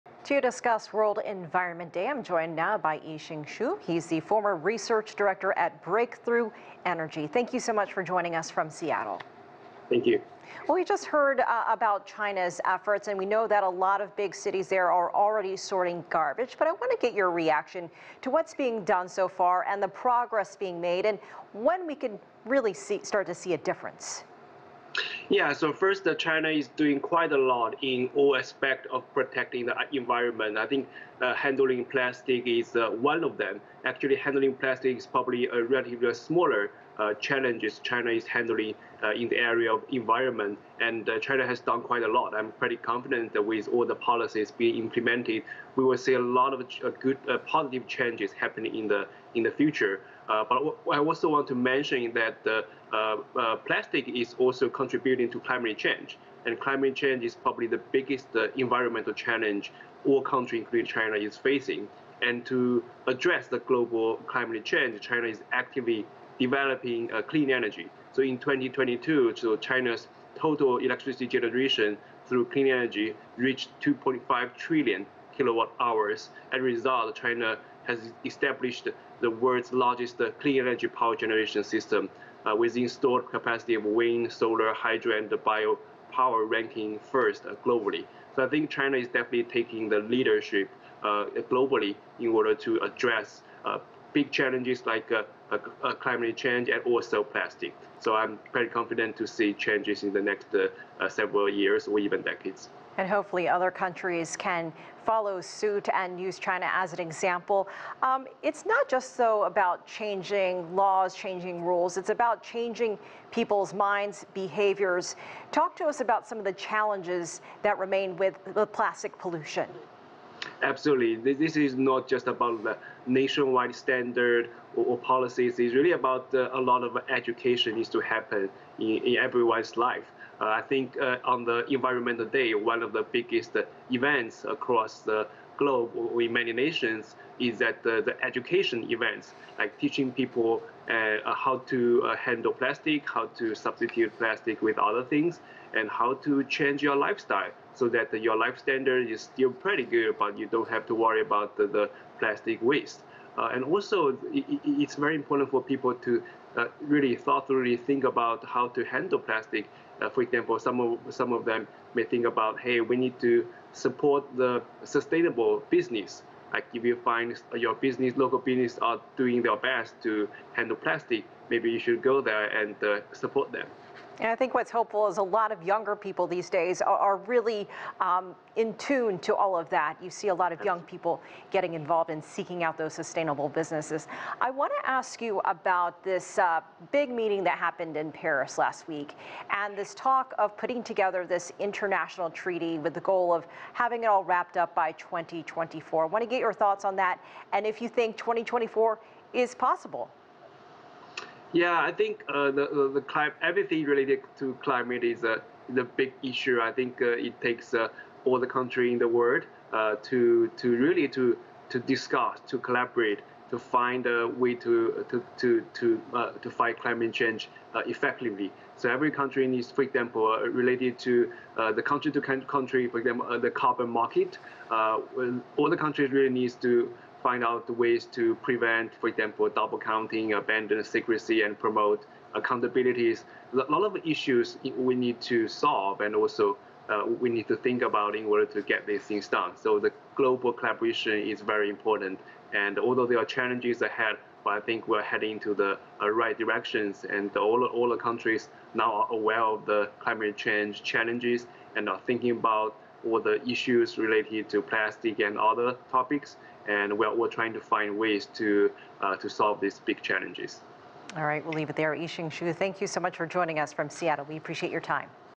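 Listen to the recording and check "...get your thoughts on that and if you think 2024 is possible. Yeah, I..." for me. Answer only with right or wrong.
right.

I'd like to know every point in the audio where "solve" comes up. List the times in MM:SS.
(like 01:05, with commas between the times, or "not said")
03:55, 04:19.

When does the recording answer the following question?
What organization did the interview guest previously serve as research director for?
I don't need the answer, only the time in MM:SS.
00:05.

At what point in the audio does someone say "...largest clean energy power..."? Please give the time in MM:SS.
01:19.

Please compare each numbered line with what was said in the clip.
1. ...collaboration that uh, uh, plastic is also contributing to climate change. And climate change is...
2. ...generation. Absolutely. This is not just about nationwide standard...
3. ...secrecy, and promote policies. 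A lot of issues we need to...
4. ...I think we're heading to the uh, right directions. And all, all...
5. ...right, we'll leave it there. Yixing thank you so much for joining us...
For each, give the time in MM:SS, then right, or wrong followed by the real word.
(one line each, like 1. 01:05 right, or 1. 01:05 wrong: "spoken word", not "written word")
1. 00:51 wrong: "mention", not "collaboration"
2. 01:59 wrong: "pollution", not "generation"
3. 03:50 wrong: "accountabilities", not "policies"
4. 04:04 right
5. 04:21 right.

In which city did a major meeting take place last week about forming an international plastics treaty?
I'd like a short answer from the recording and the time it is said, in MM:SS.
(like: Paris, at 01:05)
Paris, at 03:08.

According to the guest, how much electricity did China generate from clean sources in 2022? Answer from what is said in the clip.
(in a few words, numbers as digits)
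2.5 trillion kilowatt hours.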